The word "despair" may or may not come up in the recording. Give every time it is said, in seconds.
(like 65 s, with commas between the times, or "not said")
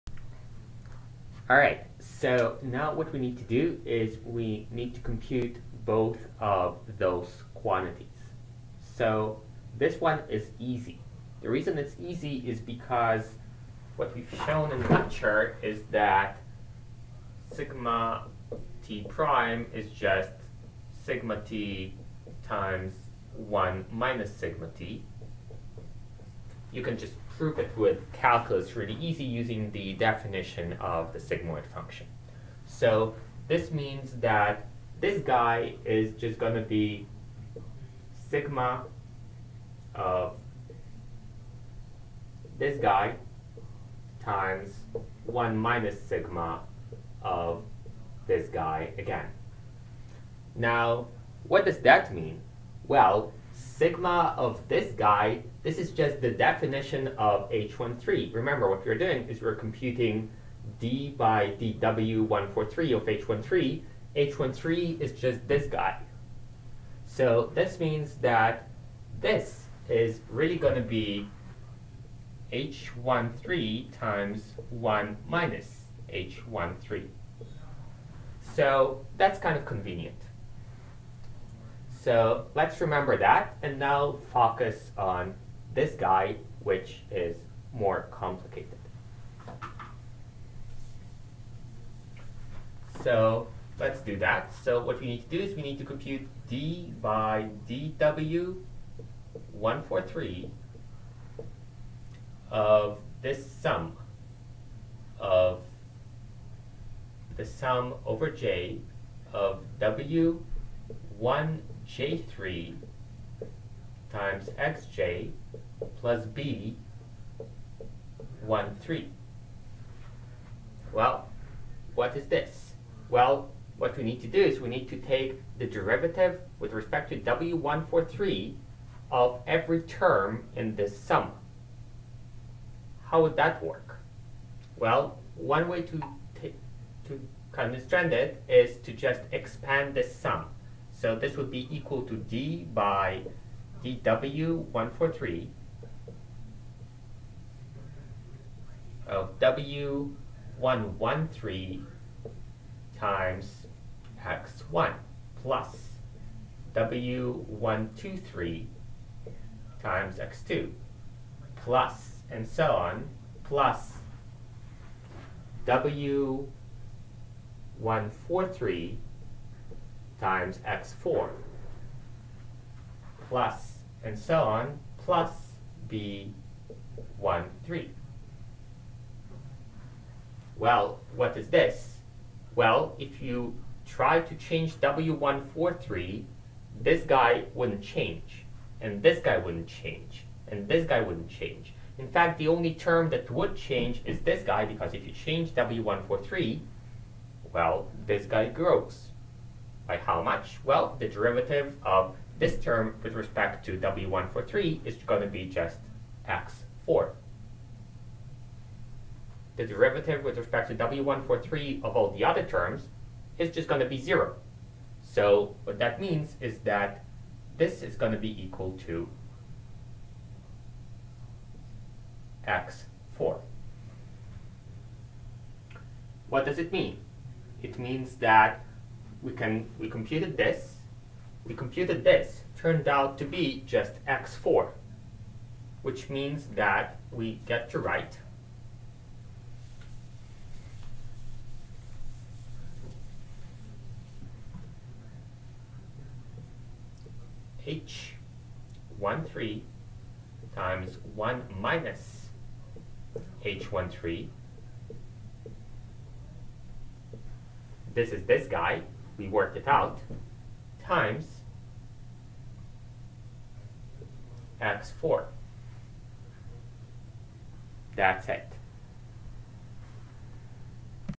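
not said.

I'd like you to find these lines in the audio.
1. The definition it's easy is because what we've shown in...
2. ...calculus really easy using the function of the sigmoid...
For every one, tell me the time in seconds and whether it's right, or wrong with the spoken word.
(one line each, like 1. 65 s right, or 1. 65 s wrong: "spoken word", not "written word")
1. 11 s wrong: "reason", not "definition"
2. 28 s wrong: "definition", not "function".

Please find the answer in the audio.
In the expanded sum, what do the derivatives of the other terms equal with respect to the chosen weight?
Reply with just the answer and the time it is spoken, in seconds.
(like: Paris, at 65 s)
0, at 213 s.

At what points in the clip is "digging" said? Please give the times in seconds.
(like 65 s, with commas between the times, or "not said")
not said.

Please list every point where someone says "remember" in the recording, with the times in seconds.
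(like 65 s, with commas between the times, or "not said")
58 s, 82 s.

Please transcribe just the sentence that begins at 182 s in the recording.
Well, if you try to change W143, this guy wouldn't change, and this guy wouldn't change, and this guy wouldn't change.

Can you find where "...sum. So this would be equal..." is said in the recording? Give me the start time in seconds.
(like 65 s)
140 s.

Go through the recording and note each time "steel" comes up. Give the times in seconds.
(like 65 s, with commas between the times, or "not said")
not said.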